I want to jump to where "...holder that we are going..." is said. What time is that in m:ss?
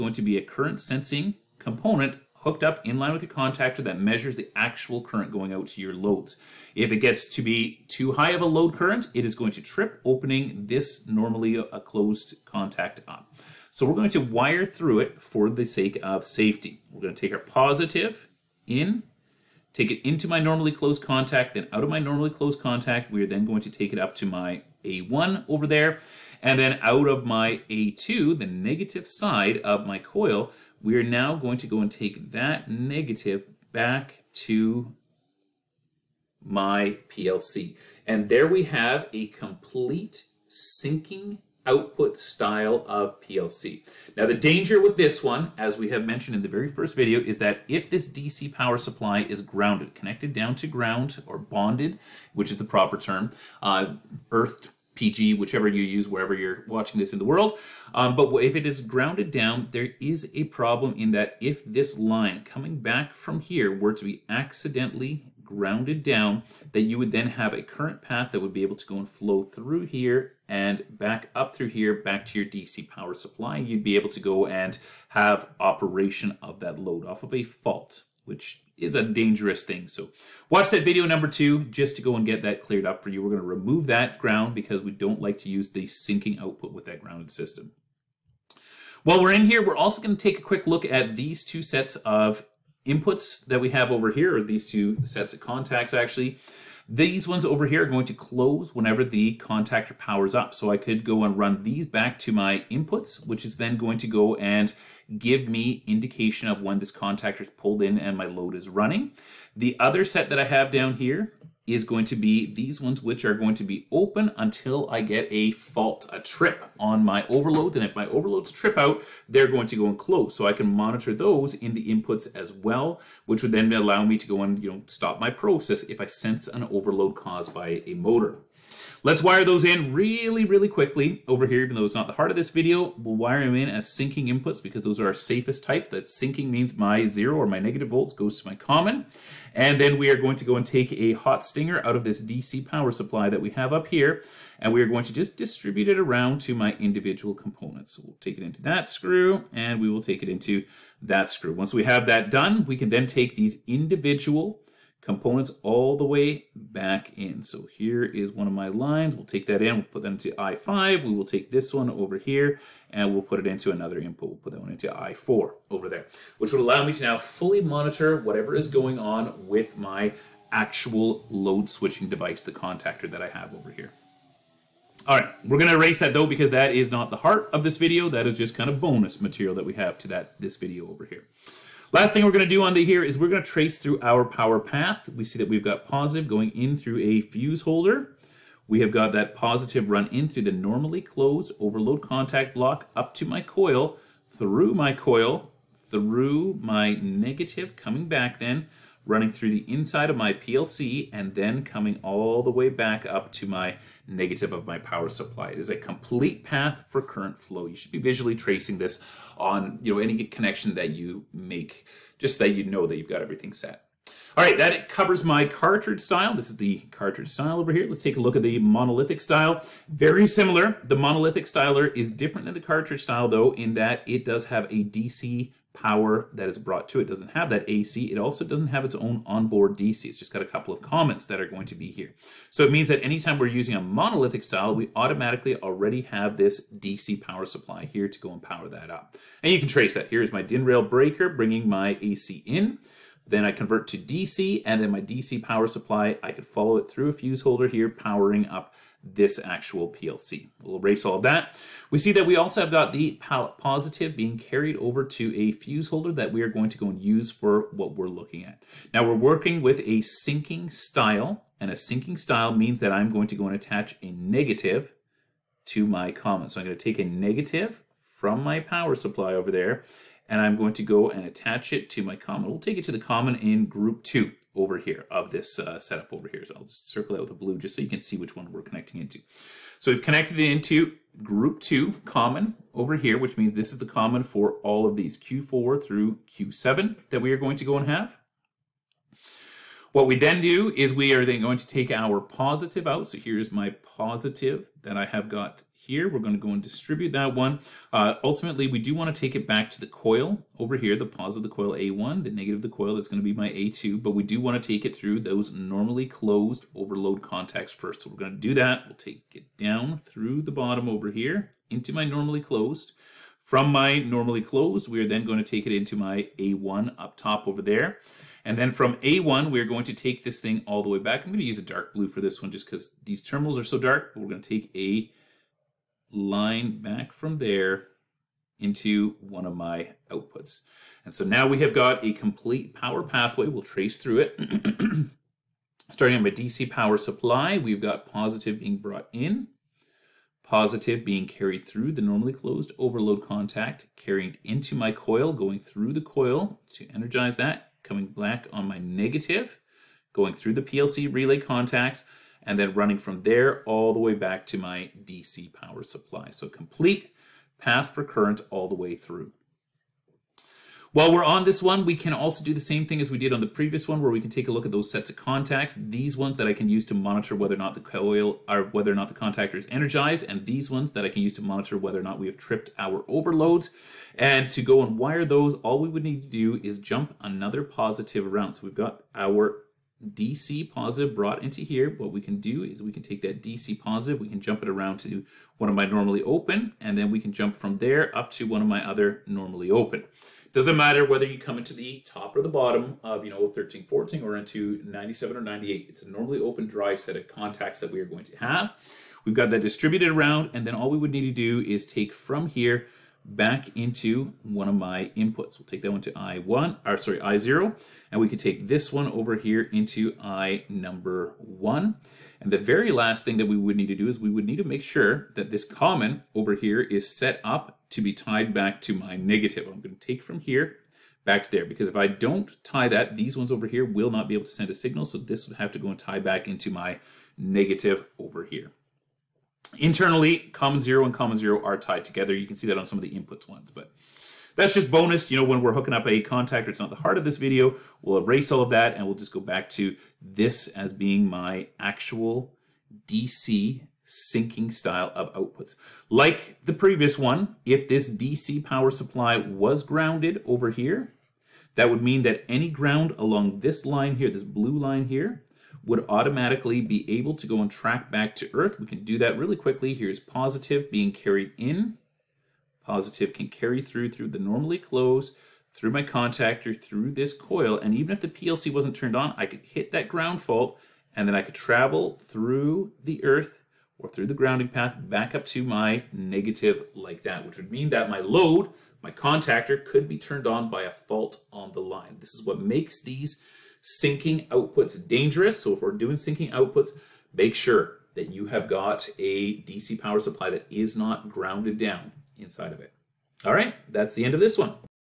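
4:15.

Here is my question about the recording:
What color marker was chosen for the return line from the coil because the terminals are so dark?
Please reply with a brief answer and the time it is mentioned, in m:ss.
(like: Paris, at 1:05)
dark blue, at 5:21.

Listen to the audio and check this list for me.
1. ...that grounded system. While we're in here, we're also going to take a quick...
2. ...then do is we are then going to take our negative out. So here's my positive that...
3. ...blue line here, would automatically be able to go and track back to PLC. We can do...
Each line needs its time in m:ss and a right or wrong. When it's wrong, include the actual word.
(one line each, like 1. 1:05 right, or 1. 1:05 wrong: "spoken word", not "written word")
1. 1:26 right
2. 4:50 wrong: "positive", not "negative"
3. 7:34 wrong: "Earth", not "PLC".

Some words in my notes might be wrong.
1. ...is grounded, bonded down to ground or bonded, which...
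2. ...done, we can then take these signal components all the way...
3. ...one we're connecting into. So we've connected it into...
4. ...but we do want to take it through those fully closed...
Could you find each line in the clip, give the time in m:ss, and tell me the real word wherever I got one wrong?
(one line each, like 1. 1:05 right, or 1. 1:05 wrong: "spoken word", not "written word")
1. 0:49 wrong: "connected", not "bonded"
2. 2:32 wrong: "individual", not "signal"
3. 4:38 right
4. 5:04 wrong: "normally", not "fully".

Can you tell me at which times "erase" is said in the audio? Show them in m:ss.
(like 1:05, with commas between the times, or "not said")
2:55, 4:10, 7:18.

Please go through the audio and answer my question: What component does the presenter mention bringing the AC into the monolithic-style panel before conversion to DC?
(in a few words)
DIN rail breaker.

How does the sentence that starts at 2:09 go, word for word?
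Let's wire those in really, really quickly over here, even though it's not the heart of this video.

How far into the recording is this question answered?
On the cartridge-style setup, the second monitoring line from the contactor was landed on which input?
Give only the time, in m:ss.
2:44.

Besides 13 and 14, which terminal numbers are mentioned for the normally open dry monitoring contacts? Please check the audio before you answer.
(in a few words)
97 or 98.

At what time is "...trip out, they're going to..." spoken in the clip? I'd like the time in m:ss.
1:58.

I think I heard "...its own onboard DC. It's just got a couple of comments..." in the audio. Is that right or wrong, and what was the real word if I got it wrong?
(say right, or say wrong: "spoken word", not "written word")
right.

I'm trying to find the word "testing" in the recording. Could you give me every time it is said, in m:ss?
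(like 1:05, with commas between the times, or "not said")
not said.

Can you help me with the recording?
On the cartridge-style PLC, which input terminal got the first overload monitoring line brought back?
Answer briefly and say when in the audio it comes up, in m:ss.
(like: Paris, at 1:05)
I5, at 2:40.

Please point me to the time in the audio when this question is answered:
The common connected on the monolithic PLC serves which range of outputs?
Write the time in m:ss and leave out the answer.
4:45.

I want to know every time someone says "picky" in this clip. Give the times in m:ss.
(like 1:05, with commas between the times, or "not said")
not said.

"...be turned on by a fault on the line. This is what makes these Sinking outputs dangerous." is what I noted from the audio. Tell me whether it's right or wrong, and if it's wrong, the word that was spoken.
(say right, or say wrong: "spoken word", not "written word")
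right.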